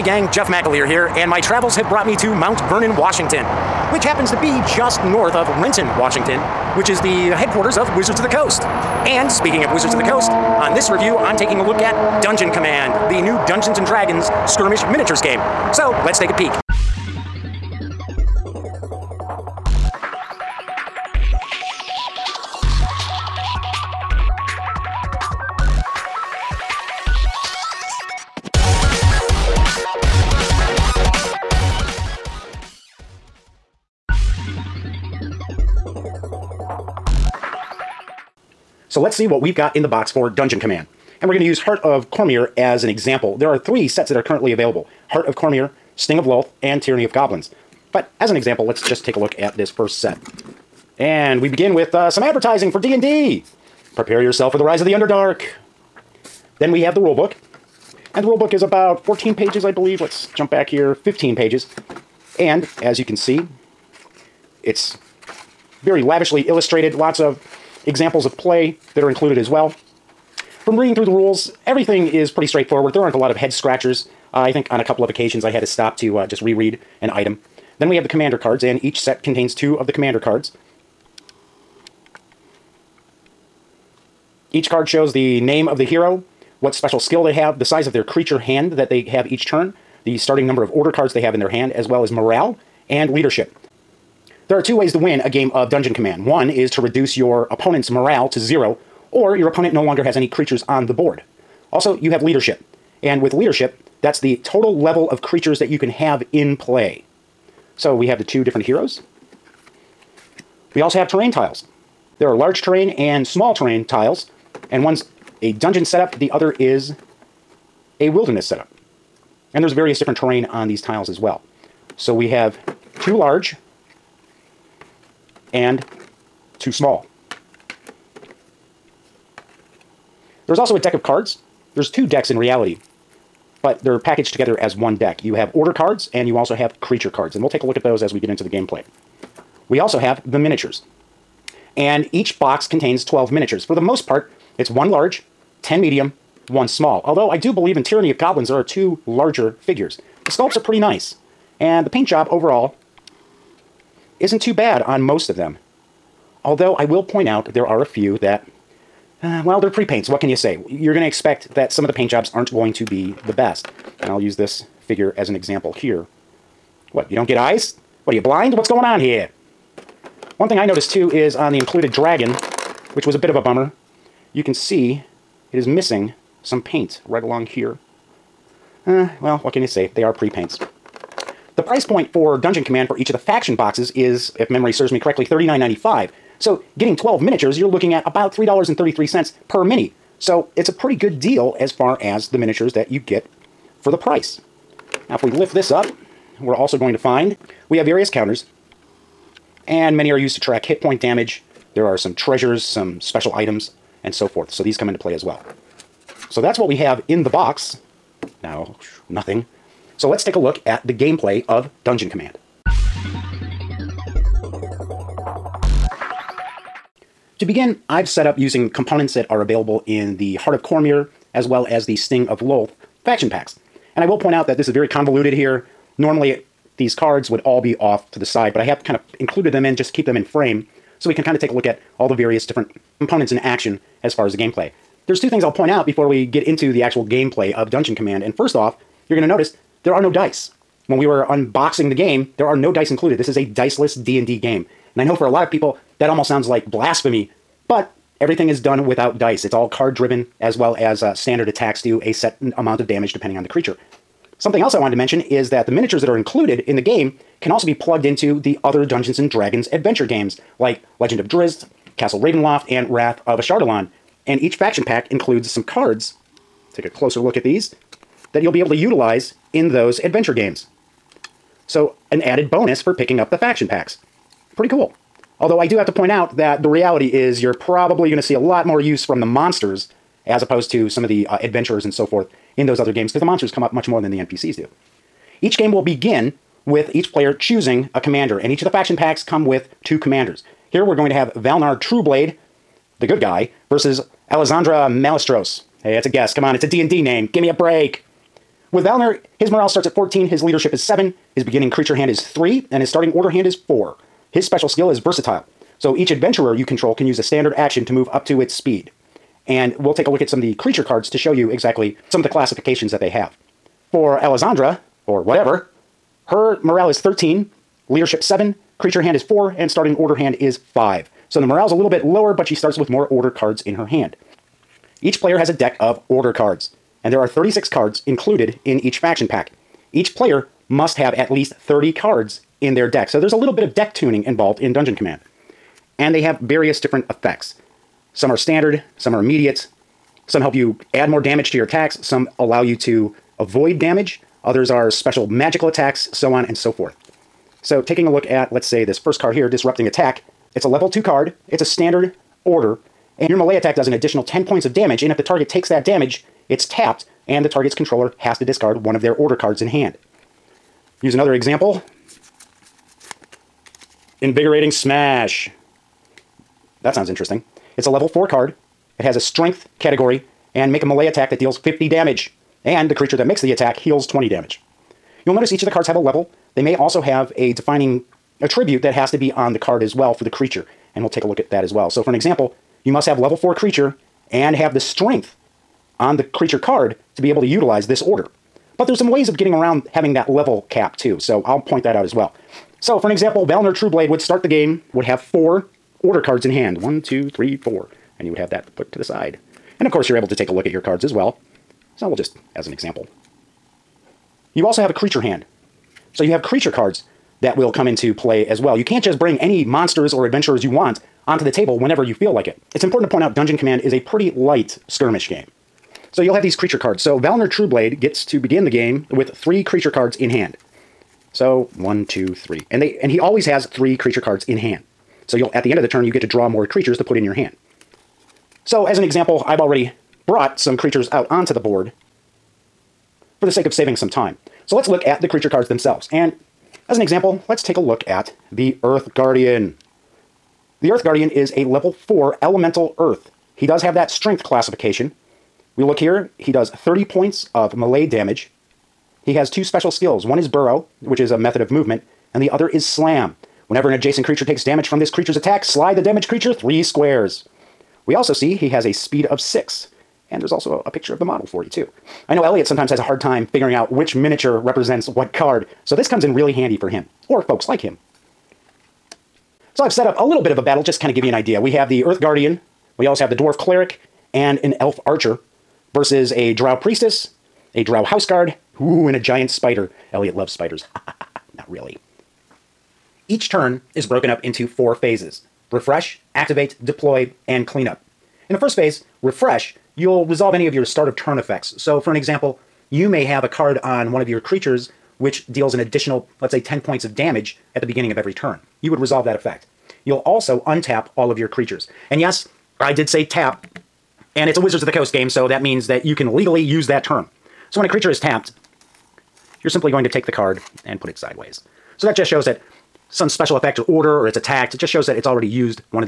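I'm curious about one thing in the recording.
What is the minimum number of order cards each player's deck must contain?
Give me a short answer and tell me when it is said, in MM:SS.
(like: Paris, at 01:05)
30, at 05:31.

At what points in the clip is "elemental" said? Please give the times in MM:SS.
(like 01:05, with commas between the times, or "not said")
07:22.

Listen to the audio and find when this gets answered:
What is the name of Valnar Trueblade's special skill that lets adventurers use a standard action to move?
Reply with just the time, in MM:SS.
05:04.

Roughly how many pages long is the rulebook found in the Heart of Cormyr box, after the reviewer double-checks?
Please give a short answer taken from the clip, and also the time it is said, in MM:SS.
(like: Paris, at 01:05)
15, at 01:00.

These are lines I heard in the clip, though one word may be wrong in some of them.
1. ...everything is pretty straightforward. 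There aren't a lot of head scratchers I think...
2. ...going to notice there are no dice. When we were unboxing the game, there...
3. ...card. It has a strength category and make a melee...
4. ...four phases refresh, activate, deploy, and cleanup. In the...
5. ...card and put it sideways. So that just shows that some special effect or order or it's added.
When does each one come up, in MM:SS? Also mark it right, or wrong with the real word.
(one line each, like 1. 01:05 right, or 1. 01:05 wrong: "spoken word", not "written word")
1. 01:11 right
2. 03:59 right
3. 06:08 right
4. 08:04 right
5. 08:30 wrong: "attacked", not "added".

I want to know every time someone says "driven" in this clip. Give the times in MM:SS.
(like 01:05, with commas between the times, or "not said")
04:09.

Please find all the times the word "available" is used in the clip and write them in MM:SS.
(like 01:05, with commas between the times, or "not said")
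00:44, 03:39.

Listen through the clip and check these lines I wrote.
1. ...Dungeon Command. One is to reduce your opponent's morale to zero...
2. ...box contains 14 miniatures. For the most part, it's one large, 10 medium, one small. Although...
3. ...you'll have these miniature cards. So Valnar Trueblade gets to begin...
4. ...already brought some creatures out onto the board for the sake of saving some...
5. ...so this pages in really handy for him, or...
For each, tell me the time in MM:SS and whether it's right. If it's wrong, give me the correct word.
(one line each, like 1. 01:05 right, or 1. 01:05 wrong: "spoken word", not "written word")
1. 01:35 right
2. 02:22 wrong: "12", not "14"
3. 06:56 wrong: "creature", not "miniature"
4. 07:09 right
5. 07:45 wrong: "comes", not "pages".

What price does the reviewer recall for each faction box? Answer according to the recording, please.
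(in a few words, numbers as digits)
$39.95.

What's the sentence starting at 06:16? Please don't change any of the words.
They may also have a defining attribute that has to be on the card as well for the creature.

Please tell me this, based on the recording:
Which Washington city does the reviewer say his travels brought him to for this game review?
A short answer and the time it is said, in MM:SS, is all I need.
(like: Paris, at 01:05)
Mount Vernon, at 00:02.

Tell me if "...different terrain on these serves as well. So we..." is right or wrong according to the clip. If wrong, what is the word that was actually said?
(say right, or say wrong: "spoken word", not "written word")
wrong: "tiles", not "serves".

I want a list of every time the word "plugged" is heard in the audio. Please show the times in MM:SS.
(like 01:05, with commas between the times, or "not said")
04:17.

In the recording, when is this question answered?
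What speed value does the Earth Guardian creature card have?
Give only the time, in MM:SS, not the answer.
07:39.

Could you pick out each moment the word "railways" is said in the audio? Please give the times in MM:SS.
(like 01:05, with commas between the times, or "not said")
not said.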